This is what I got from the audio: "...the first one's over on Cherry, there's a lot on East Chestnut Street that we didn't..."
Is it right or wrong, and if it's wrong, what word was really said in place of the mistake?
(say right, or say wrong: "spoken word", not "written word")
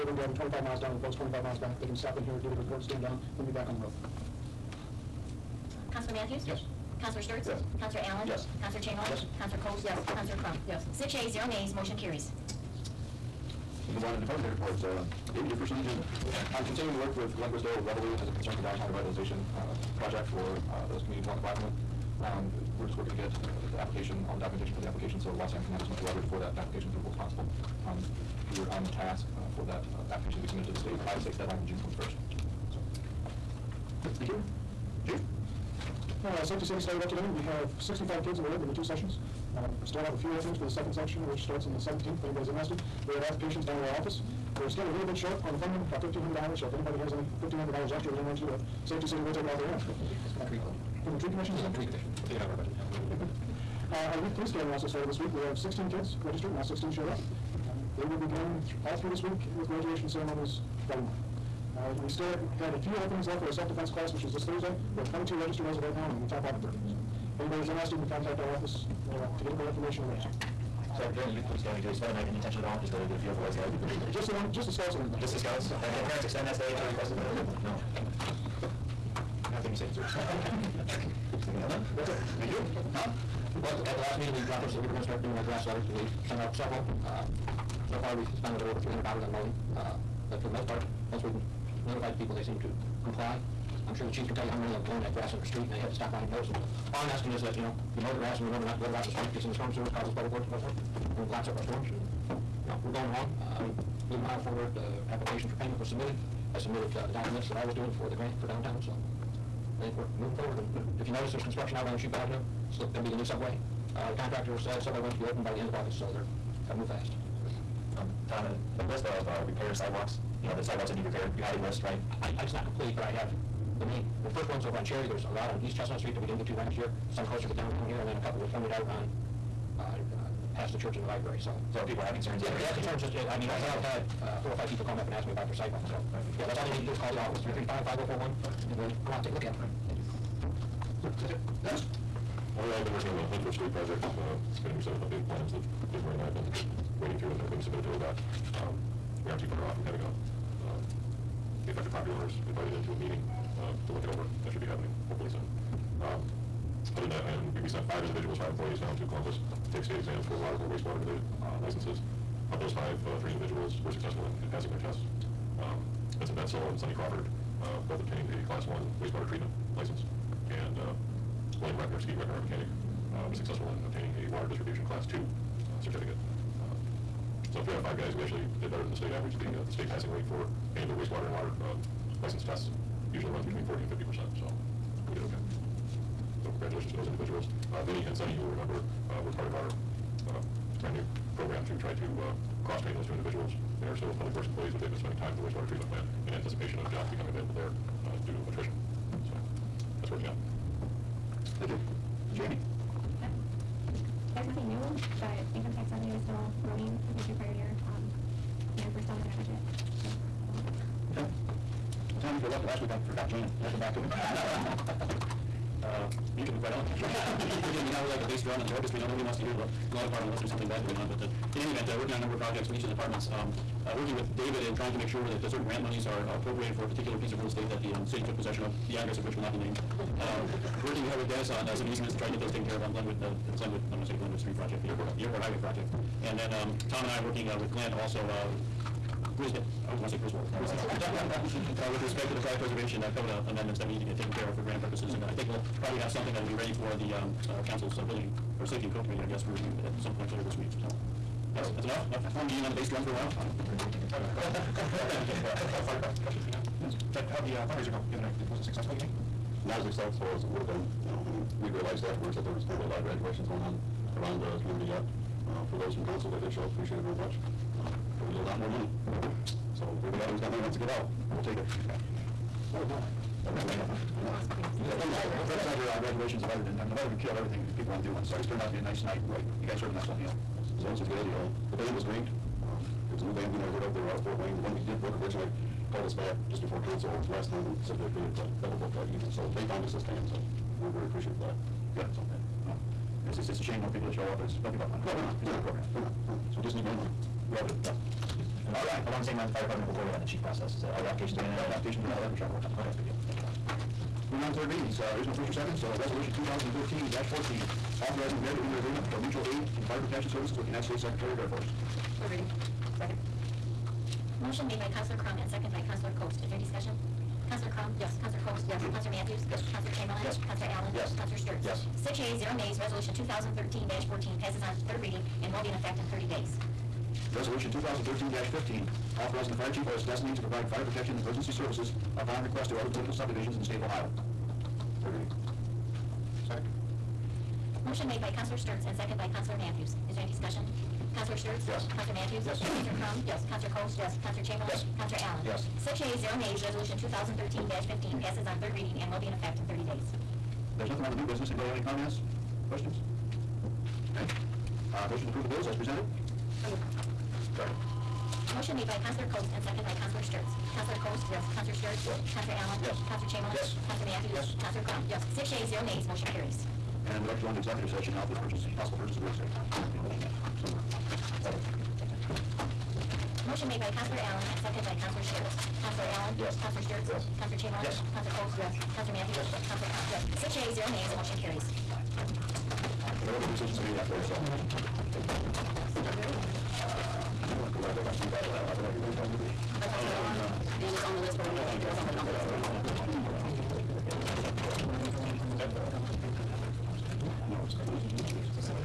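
right.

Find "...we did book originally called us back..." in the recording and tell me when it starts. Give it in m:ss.
4:44.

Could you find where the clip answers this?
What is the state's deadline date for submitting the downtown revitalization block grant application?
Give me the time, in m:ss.
0:31.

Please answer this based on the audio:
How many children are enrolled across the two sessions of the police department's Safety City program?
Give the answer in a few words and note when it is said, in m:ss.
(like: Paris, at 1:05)
65, at 0:37.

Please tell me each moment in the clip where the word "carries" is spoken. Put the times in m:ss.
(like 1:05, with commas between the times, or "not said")
0:11, 6:06, 6:21.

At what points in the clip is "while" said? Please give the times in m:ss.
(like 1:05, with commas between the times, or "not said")
4:13.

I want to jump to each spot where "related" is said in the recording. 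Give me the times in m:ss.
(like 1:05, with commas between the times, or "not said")
2:41.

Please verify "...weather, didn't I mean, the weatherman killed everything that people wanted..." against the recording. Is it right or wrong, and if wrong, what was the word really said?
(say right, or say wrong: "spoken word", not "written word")
right.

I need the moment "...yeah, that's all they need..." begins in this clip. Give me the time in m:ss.
2:16.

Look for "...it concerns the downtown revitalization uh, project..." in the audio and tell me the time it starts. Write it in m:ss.
0:18.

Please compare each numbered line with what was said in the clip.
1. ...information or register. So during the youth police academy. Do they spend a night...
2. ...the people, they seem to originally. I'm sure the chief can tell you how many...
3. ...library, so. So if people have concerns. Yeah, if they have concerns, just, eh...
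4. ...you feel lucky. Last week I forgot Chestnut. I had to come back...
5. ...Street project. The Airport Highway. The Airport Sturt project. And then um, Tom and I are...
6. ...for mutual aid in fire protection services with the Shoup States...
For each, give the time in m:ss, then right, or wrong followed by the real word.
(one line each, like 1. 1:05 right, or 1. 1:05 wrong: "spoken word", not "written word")
1. 1:09 right
2. 1:32 wrong: "comply", not "originally"
3. 2:11 right
4. 3:32 wrong: "Jan", not "Chestnut"
5. 3:54 wrong: "Highway", not "Sturt"
6. 5:09 wrong: "United", not "Shoup".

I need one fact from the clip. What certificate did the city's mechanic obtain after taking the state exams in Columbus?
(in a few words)
water distribution class two.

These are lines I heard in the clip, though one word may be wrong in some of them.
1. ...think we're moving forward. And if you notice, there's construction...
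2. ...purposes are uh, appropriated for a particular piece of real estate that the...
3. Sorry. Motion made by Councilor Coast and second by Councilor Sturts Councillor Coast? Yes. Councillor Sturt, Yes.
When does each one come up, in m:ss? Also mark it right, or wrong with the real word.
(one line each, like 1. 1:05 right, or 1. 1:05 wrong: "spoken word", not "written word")
1. 1:49 right
2. 3:45 wrong: "monies", not "purposes"
3. 5:57 right.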